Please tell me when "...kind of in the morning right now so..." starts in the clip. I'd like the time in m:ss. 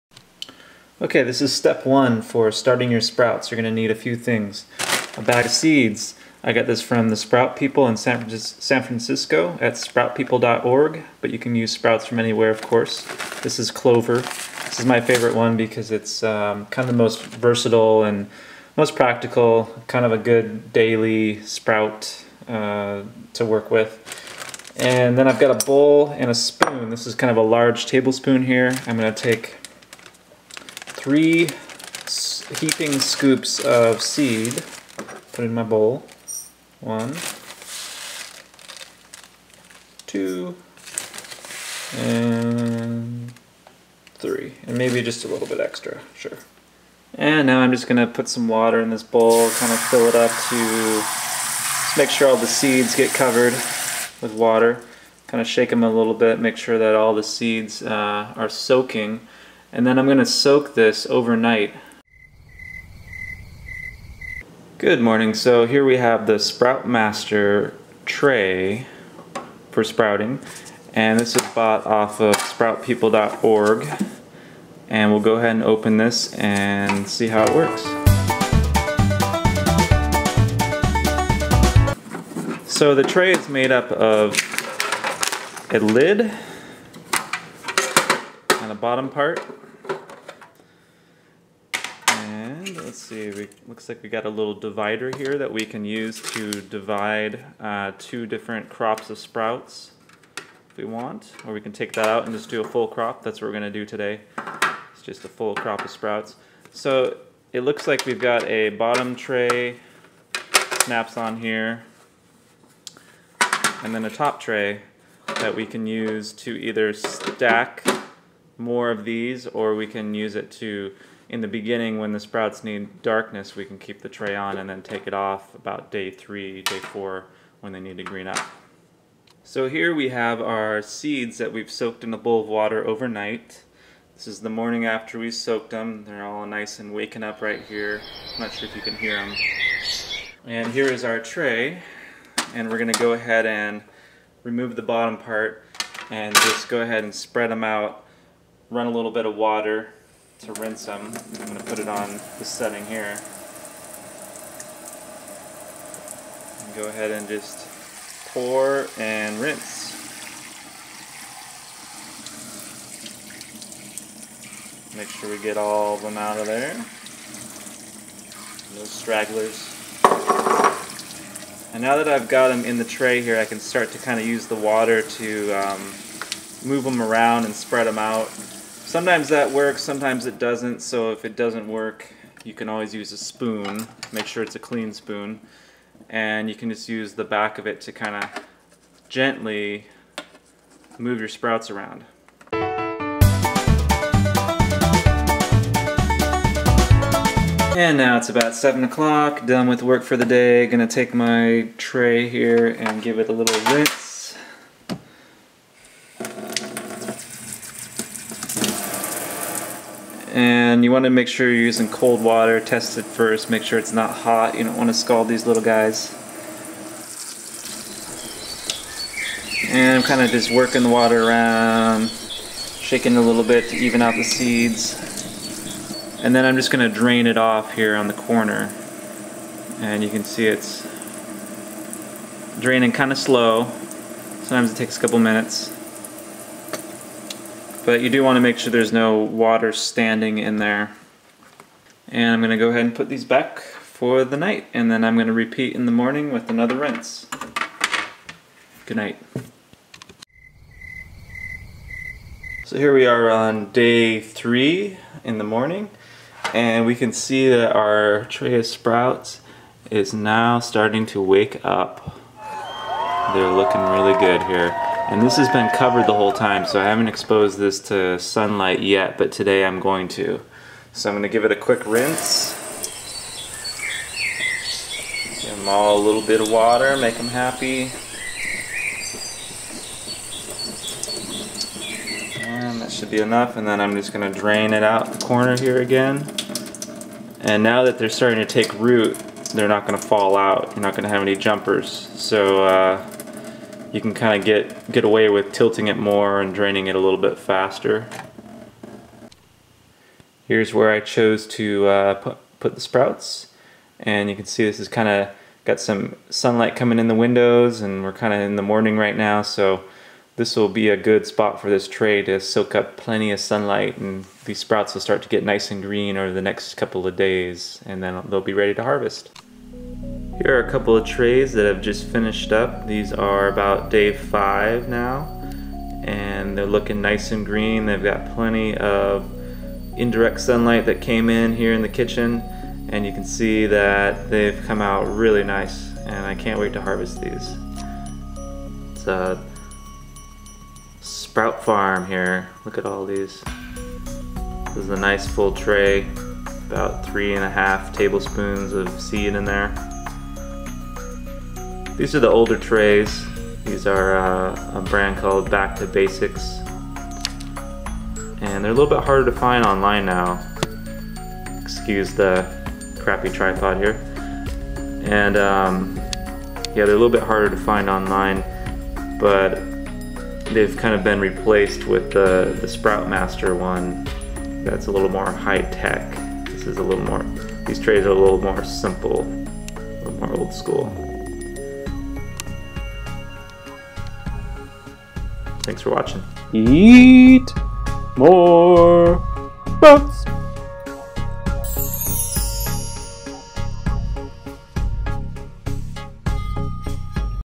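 5:08.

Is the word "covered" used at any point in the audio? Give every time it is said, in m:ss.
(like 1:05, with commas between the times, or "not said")
0:53, 4:25.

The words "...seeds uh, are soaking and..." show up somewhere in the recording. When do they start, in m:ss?
0:57.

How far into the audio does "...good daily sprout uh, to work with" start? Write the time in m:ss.
0:20.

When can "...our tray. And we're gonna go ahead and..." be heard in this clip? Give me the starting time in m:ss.
2:21.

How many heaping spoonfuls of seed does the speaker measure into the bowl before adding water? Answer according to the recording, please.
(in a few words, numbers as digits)
3.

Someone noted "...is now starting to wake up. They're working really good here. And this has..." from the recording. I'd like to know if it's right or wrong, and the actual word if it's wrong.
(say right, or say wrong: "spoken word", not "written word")
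wrong: "looking", not "working".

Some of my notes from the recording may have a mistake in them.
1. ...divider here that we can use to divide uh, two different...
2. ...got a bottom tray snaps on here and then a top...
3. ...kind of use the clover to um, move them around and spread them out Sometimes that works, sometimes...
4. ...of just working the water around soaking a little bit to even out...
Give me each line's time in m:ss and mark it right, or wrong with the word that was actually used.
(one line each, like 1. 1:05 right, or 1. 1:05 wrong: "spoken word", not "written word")
1. 1:34 right
2. 1:48 right
3. 2:53 wrong: "water", not "clover"
4. 3:40 wrong: "shaking", not "soaking".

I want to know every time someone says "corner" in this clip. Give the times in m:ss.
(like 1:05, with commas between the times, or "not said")
3:48, 4:45.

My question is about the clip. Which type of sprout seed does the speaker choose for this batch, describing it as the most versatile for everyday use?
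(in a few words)
Clover.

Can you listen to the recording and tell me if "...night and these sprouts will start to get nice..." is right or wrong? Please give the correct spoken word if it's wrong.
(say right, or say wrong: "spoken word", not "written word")
wrong: "sunlight", not "night".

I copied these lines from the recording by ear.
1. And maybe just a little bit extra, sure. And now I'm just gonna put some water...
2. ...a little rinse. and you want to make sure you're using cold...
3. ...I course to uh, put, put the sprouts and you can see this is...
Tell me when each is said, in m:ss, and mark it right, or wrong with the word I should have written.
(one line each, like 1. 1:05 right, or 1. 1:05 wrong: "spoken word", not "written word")
1. 0:44 right
2. 3:23 right
3. 5:00 wrong: "chose", not "course".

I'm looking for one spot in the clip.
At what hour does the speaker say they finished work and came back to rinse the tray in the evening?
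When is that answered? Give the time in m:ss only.
3:18.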